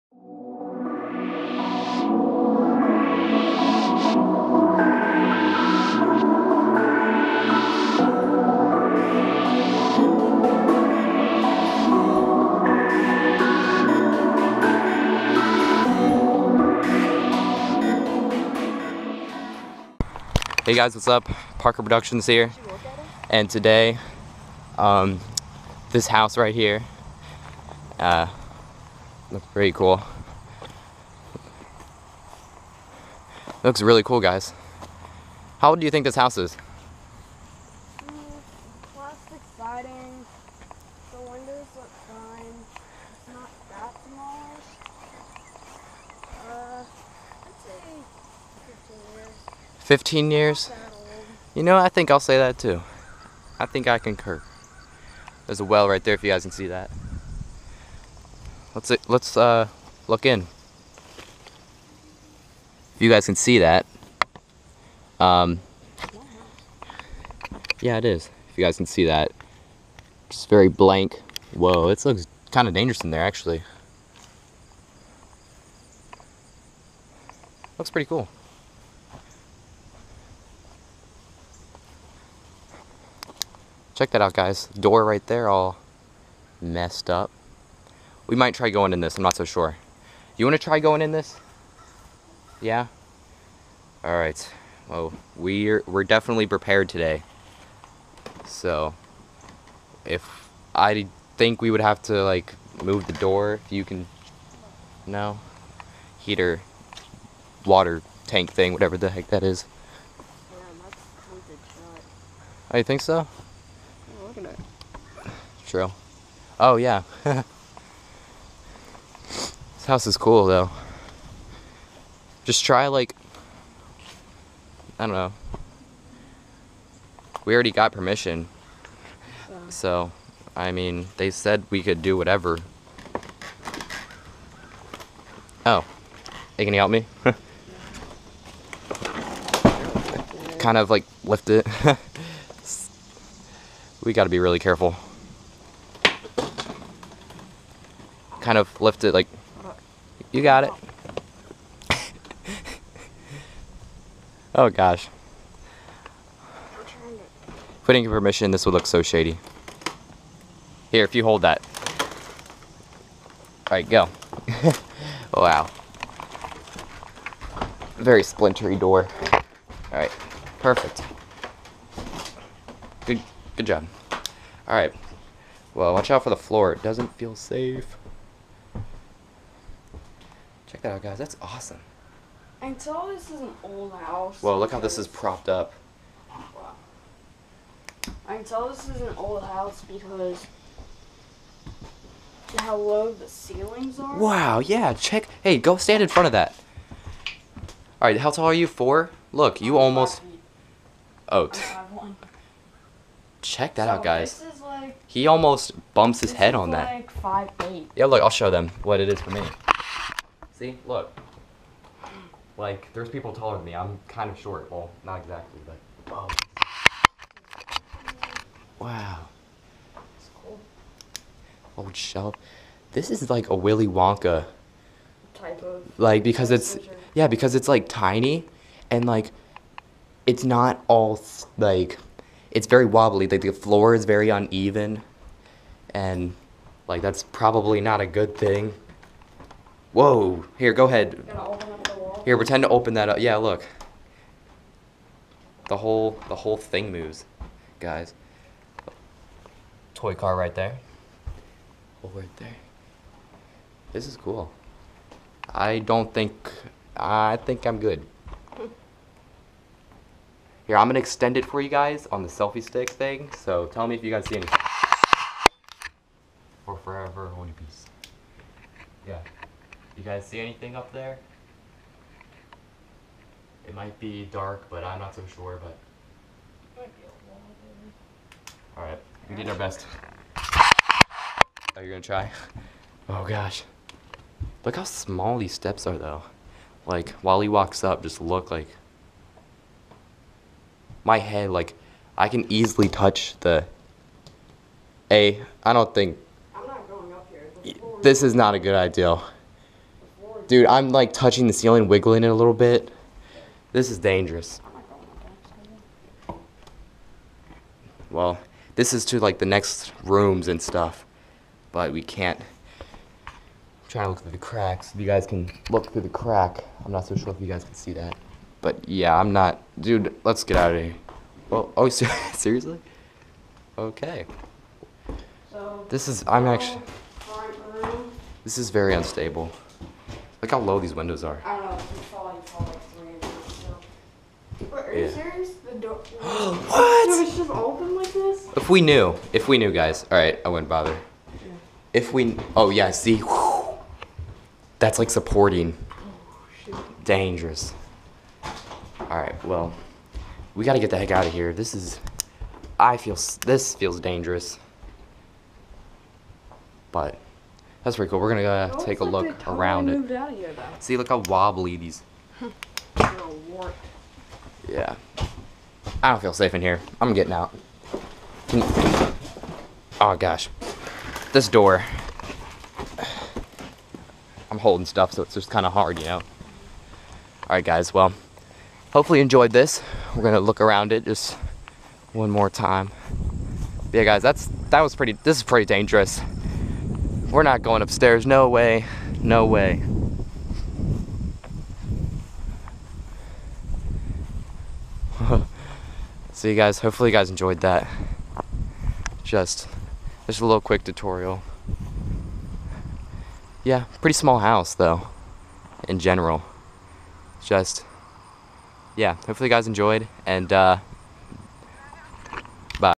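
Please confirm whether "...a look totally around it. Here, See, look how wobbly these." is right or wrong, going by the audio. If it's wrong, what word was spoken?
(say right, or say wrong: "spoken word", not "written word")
right.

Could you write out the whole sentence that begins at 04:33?
It might be dark, but I'm not so sure, but...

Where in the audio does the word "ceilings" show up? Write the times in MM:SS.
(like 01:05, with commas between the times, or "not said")
03:13, 05:01.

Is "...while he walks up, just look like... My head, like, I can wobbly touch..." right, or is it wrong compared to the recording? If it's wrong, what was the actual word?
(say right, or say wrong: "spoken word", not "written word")
wrong: "easily", not "wobbly".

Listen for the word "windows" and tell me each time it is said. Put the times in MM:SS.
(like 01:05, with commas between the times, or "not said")
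00:41, 05:30.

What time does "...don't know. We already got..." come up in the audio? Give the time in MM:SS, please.
02:05.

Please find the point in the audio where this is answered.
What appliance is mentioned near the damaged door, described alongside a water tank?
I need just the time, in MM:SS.
01:46.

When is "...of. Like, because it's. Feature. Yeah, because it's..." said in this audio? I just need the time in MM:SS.
03:45.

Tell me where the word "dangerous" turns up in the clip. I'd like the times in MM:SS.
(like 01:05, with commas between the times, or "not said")
01:12, 05:03, 05:47, 05:53, 06:25.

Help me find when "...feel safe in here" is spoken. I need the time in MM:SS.
06:06.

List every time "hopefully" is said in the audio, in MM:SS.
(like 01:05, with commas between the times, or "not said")
06:18, 06:36, 06:49.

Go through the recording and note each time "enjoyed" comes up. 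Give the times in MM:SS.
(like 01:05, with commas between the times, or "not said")
06:19, 06:37, 06:49.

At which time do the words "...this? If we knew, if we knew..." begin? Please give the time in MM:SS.
05:38.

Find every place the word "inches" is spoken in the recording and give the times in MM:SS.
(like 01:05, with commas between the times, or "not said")
05:33.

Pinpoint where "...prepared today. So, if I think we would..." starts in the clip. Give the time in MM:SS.
01:36.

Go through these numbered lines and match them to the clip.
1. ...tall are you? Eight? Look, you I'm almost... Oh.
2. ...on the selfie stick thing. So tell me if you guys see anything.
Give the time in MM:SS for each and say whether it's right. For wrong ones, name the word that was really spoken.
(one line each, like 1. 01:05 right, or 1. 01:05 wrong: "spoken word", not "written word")
1. 03:18 wrong: "Four", not "Eight"
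2. 04:22 right.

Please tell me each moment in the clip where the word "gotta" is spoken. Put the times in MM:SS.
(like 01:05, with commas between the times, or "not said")
02:24, 05:50.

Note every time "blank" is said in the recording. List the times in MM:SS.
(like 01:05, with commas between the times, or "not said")
01:10.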